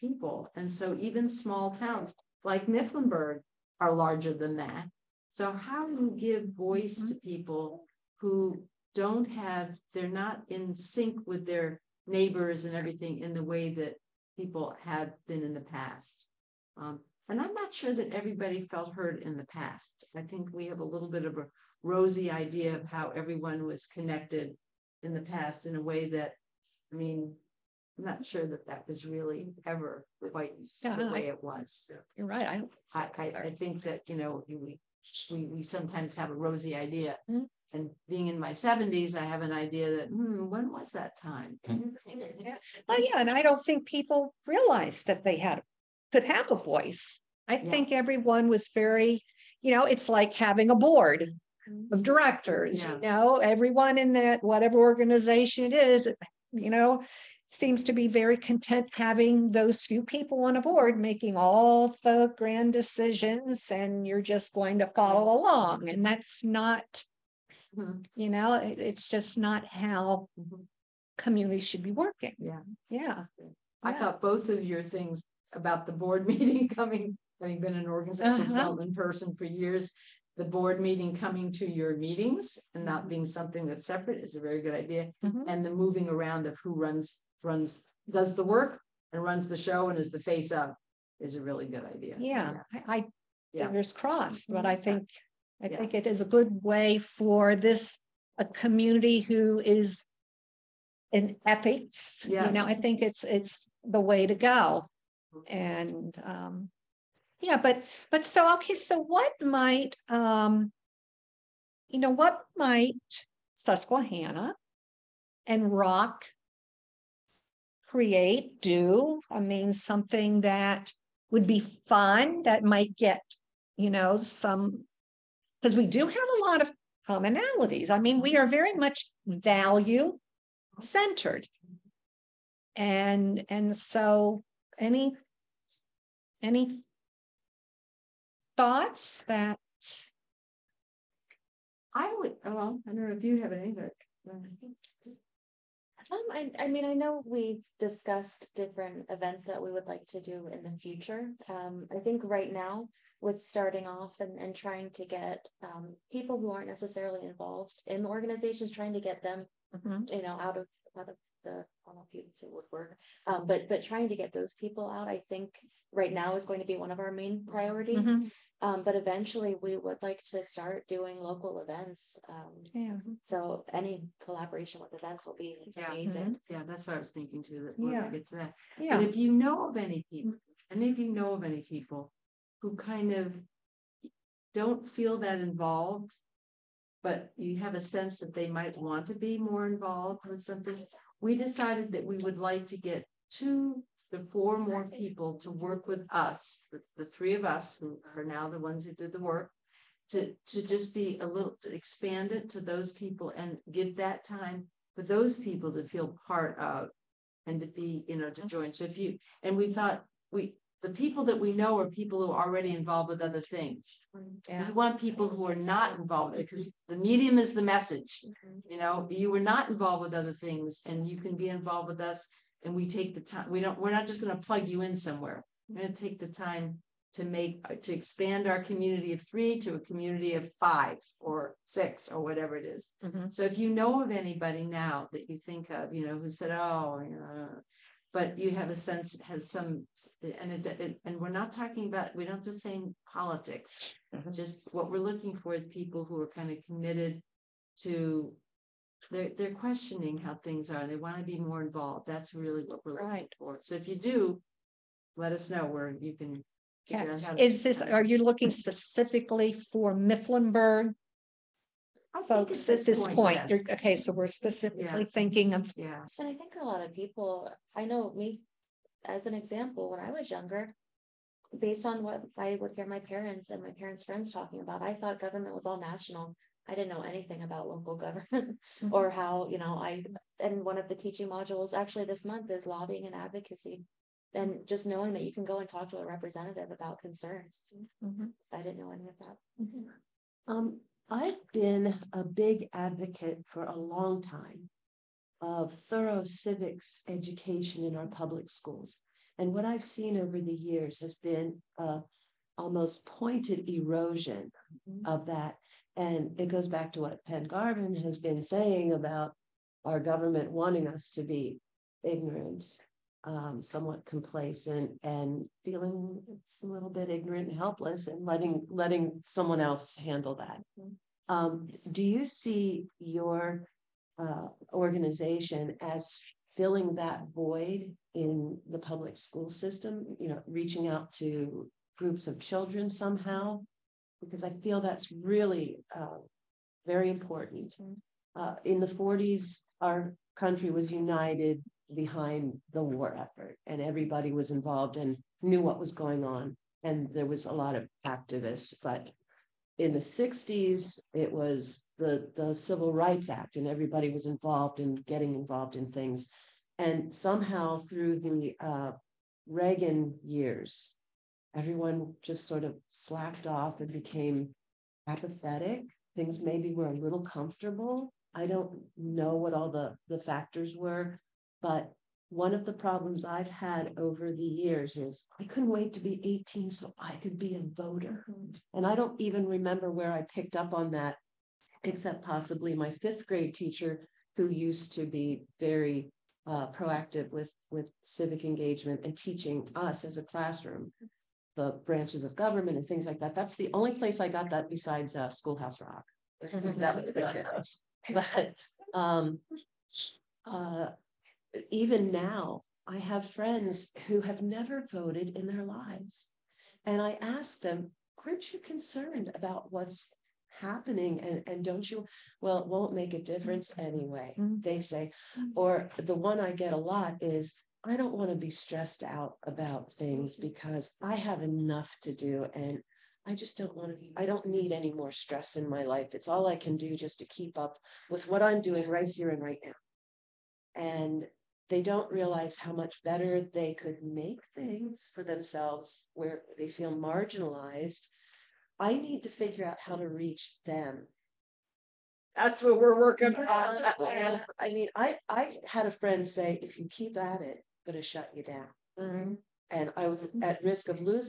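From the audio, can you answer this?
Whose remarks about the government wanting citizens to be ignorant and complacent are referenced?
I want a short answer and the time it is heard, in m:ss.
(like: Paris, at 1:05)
Penn Garvin, at 5:07.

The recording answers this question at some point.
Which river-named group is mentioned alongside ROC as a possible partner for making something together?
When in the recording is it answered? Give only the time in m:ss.
1:53.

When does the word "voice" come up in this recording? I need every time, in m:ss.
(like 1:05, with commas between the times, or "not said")
0:06, 0:46.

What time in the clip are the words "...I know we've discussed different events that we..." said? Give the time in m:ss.
2:26.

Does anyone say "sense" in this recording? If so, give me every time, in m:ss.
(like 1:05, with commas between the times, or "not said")
3:07, 3:58.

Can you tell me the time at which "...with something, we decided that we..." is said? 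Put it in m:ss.
3:10.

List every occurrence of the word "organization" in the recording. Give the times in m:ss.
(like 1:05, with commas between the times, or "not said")
0:54, 1:17, 2:38, 5:24.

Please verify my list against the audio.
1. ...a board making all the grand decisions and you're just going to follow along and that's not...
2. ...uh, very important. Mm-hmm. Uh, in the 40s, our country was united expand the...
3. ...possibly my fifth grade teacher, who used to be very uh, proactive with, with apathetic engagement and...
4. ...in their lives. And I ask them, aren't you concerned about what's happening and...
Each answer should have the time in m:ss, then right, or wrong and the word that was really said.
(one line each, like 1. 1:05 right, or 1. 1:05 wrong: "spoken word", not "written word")
1. 1:00 right
2. 5:35 wrong: "behind", not "expand"
3. 6:22 wrong: "civic", not "apathetic"
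4. 6:45 right.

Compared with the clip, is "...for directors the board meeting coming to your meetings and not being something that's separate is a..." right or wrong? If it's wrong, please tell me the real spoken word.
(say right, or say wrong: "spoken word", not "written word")
wrong: "years", not "directors".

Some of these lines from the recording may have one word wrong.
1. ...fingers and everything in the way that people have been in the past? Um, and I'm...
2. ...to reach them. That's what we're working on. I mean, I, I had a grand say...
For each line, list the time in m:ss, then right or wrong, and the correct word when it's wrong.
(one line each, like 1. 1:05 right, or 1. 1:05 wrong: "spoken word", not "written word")
1. 0:12 wrong: "neighbors", not "fingers"
2. 7:19 wrong: "friend", not "grand".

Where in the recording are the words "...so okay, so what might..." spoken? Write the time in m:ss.
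1:48.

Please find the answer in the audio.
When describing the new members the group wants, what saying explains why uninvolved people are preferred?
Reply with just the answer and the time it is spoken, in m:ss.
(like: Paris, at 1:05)
The medium is the message, at 3:36.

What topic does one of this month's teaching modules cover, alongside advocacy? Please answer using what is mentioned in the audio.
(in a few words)
Lobbying.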